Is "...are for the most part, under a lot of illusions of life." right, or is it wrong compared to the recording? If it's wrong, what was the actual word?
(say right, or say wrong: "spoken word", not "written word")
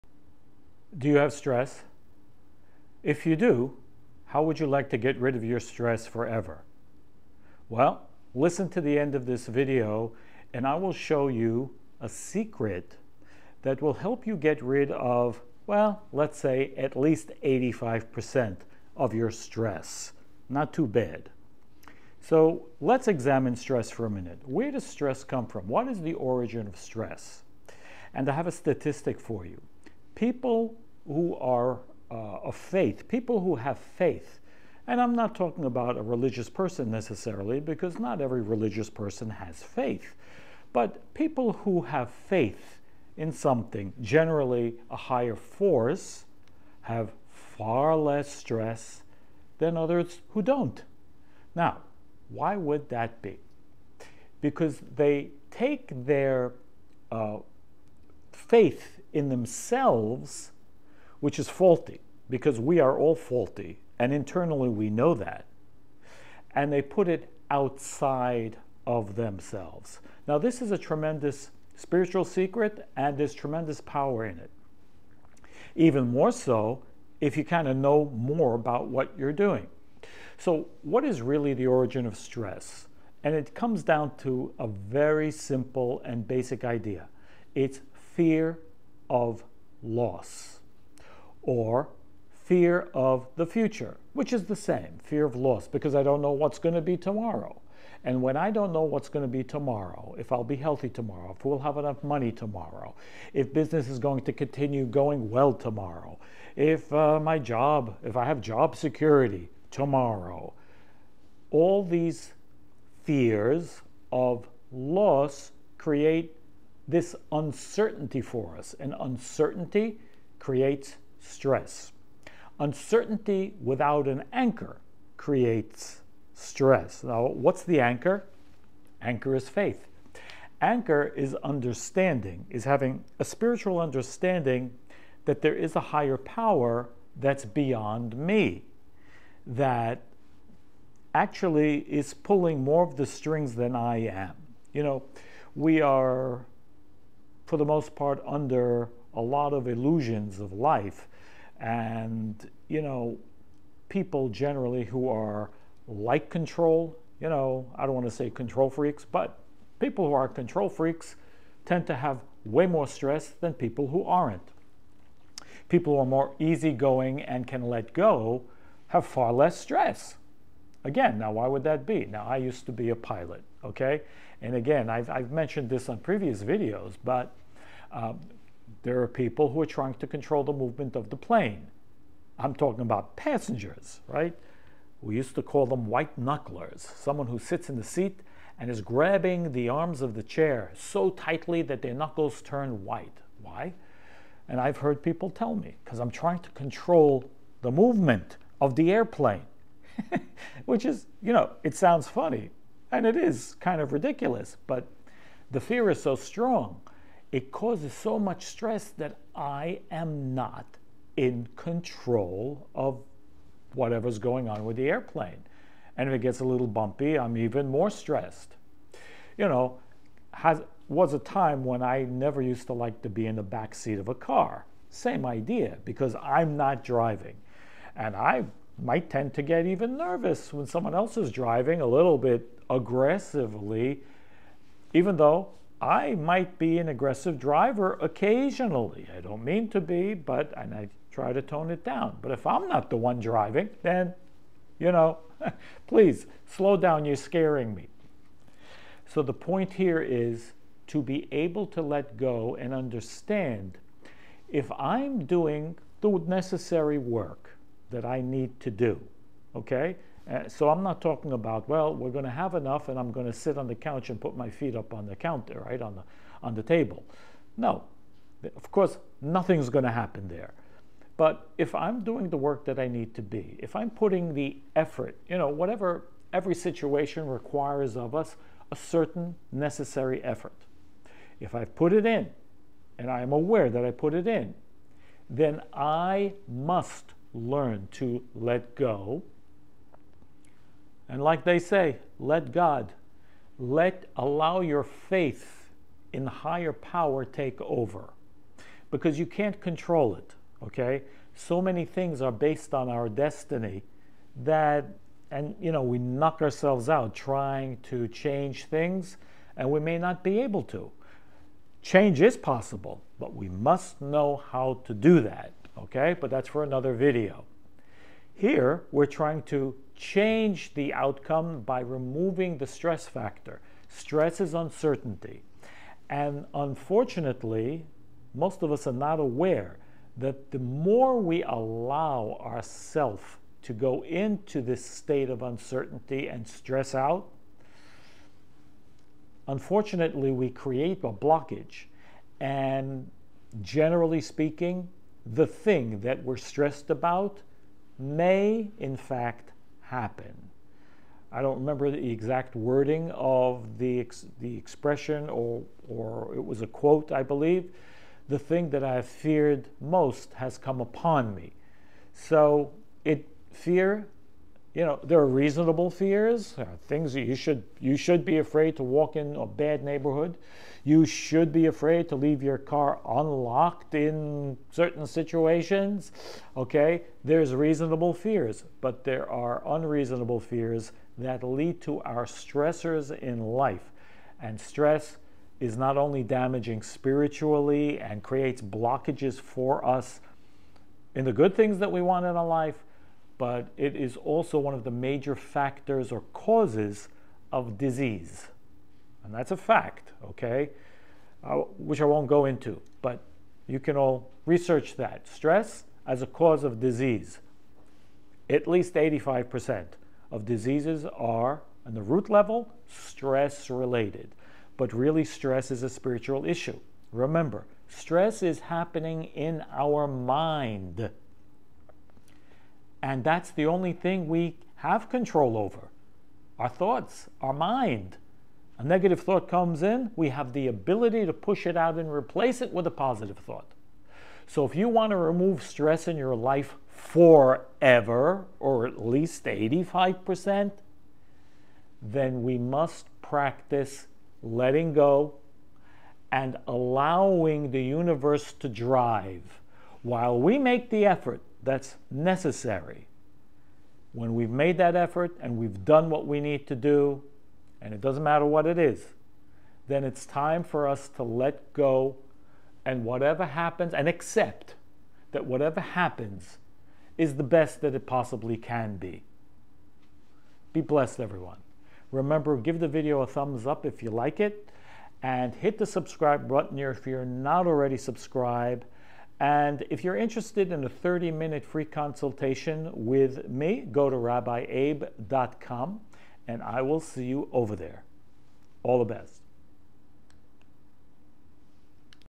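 right.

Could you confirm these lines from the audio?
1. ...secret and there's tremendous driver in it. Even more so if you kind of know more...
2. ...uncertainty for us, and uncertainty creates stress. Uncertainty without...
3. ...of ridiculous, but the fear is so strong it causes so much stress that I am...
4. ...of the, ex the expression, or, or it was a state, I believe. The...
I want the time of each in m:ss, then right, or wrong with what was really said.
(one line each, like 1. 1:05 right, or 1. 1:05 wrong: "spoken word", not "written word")
1. 1:12 wrong: "power", not "driver"
2. 1:57 right
3. 3:23 right
4. 5:53 wrong: "quote", not "state".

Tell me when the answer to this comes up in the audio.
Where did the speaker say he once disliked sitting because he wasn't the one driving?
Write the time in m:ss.
3:43.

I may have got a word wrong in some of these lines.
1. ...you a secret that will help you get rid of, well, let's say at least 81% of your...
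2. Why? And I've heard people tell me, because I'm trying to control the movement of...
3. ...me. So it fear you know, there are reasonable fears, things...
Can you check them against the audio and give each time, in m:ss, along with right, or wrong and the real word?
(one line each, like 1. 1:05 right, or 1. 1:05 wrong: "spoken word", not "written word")
1. 0:11 wrong: "85", not "81"
2. 3:13 right
3. 6:01 right.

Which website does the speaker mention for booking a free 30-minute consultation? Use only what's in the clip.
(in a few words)
rabbiabe.com.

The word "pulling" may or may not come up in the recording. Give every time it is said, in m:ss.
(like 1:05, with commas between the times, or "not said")
2:22.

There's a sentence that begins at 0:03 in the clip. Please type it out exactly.
If you do, how would you like to get rid of your stress forever?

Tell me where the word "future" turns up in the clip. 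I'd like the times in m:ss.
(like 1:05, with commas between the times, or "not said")
1:33.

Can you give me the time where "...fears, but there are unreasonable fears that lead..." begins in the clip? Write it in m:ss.
6:18.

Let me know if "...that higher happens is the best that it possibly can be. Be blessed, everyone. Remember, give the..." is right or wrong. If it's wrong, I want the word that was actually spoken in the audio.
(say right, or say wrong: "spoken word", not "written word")
wrong: "whatever", not "higher".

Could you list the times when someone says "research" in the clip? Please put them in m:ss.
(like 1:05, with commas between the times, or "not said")
6:44.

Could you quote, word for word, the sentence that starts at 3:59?
I don't mean to be, but and I try to tone it down.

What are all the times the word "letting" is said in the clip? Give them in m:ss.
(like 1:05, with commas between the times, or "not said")
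7:24.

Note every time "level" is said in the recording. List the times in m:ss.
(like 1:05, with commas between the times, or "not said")
6:52.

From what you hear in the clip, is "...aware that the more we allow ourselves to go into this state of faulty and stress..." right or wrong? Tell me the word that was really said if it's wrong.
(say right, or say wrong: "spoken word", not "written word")
wrong: "uncertainty", not "faulty".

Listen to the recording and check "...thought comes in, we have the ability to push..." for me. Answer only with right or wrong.
right.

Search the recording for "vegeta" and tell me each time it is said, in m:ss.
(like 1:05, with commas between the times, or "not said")
not said.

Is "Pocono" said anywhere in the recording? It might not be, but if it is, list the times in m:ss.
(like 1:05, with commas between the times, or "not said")
not said.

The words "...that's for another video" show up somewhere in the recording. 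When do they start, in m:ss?
5:16.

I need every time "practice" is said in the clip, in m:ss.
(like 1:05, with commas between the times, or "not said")
7:23.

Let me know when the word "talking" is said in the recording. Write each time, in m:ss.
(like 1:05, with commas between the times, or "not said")
0:35, 3:02, 4:21.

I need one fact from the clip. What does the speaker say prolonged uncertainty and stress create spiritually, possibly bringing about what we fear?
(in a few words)
A blockage.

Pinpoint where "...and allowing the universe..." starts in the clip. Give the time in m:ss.
7:26.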